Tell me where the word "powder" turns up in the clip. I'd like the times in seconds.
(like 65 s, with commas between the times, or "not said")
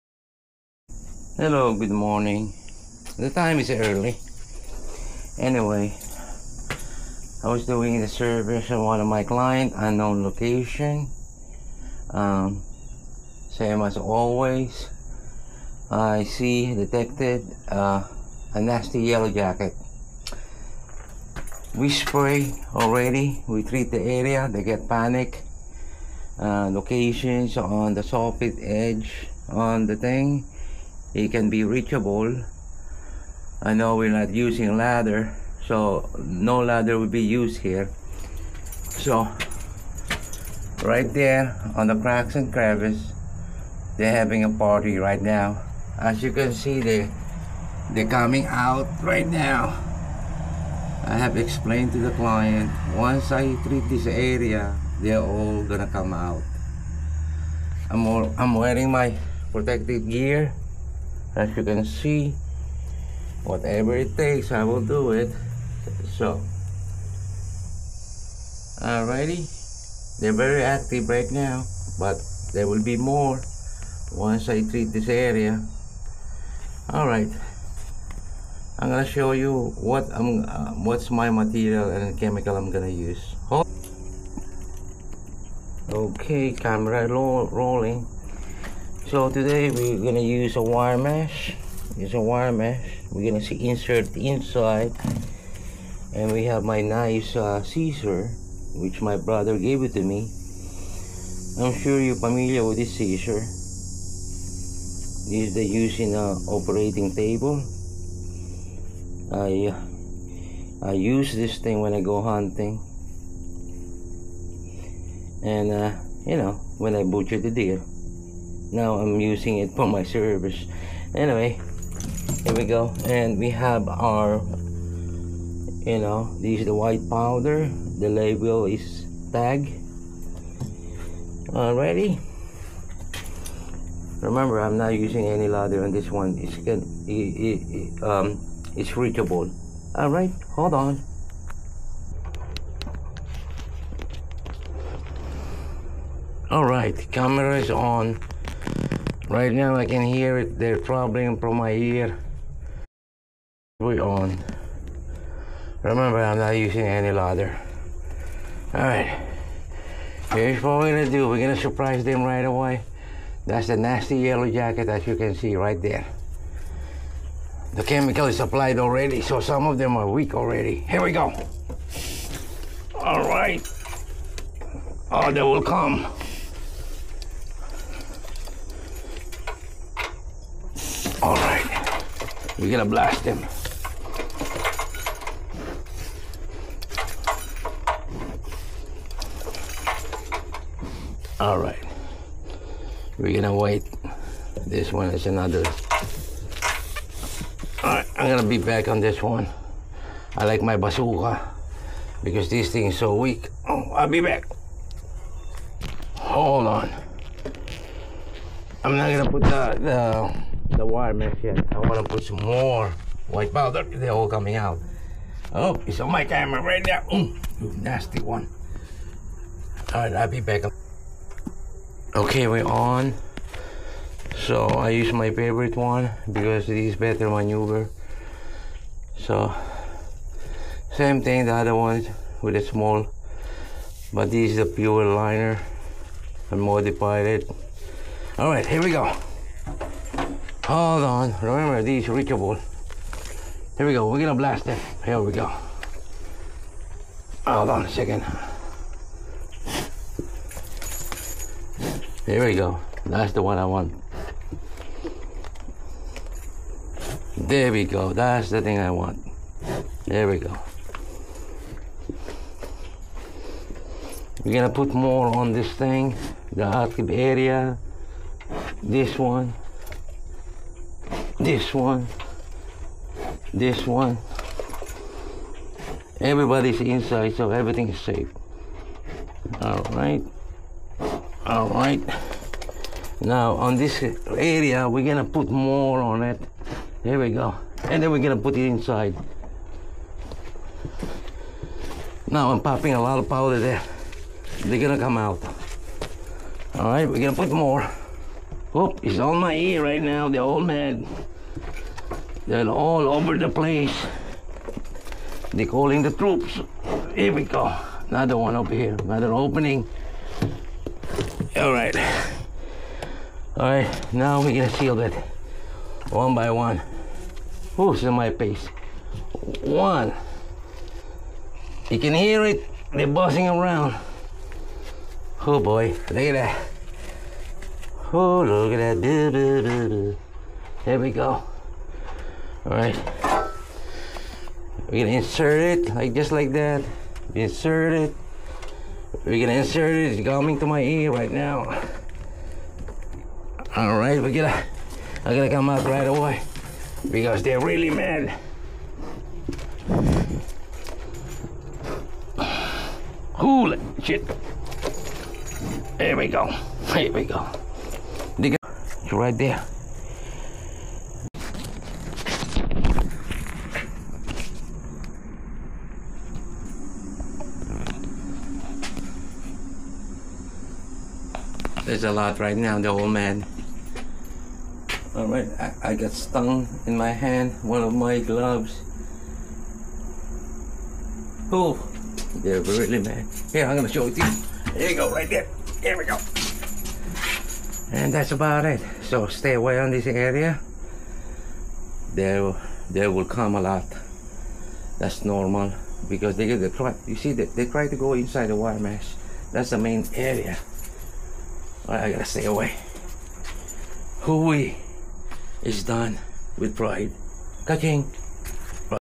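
127 s, 213 s, 293 s.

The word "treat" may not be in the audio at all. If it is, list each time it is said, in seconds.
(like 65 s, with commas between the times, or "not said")
23 s, 53 s, 74 s.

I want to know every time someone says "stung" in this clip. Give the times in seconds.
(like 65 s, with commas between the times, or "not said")
376 s.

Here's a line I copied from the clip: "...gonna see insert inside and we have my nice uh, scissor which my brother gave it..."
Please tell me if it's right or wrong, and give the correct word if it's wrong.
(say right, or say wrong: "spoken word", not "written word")
right.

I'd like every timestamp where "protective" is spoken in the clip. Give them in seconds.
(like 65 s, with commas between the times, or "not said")
59 s.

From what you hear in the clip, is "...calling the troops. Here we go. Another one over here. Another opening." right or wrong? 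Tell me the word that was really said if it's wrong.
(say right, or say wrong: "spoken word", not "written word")
right.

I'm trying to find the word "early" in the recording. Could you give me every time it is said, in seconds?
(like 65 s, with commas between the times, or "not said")
3 s.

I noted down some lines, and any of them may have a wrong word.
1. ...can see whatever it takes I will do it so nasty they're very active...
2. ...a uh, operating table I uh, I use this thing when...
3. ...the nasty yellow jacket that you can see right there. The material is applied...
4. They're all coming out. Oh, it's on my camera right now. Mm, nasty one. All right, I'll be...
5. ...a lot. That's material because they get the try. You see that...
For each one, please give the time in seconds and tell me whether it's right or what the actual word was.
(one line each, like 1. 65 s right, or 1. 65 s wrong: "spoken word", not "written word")
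1. 61 s wrong: "alrighty", not "nasty"
2. 106 s right
3. 163 s wrong: "chemical", not "material"
4. 213 s right
5. 393 s wrong: "normal", not "material".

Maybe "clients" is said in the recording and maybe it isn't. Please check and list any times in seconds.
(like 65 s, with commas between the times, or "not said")
9 s, 52 s.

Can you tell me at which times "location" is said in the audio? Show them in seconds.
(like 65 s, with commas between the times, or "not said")
10 s, 26 s.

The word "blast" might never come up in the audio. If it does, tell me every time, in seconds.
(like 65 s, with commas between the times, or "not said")
182 s, 244 s.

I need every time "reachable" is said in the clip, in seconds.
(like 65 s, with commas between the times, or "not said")
31 s, 138 s, 242 s.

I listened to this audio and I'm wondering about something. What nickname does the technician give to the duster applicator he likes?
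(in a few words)
Bazooka.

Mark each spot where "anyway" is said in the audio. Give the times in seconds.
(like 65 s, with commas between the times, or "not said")
5 s, 121 s.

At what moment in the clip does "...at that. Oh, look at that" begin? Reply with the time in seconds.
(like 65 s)
326 s.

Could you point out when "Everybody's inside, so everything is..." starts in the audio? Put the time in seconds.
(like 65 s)
276 s.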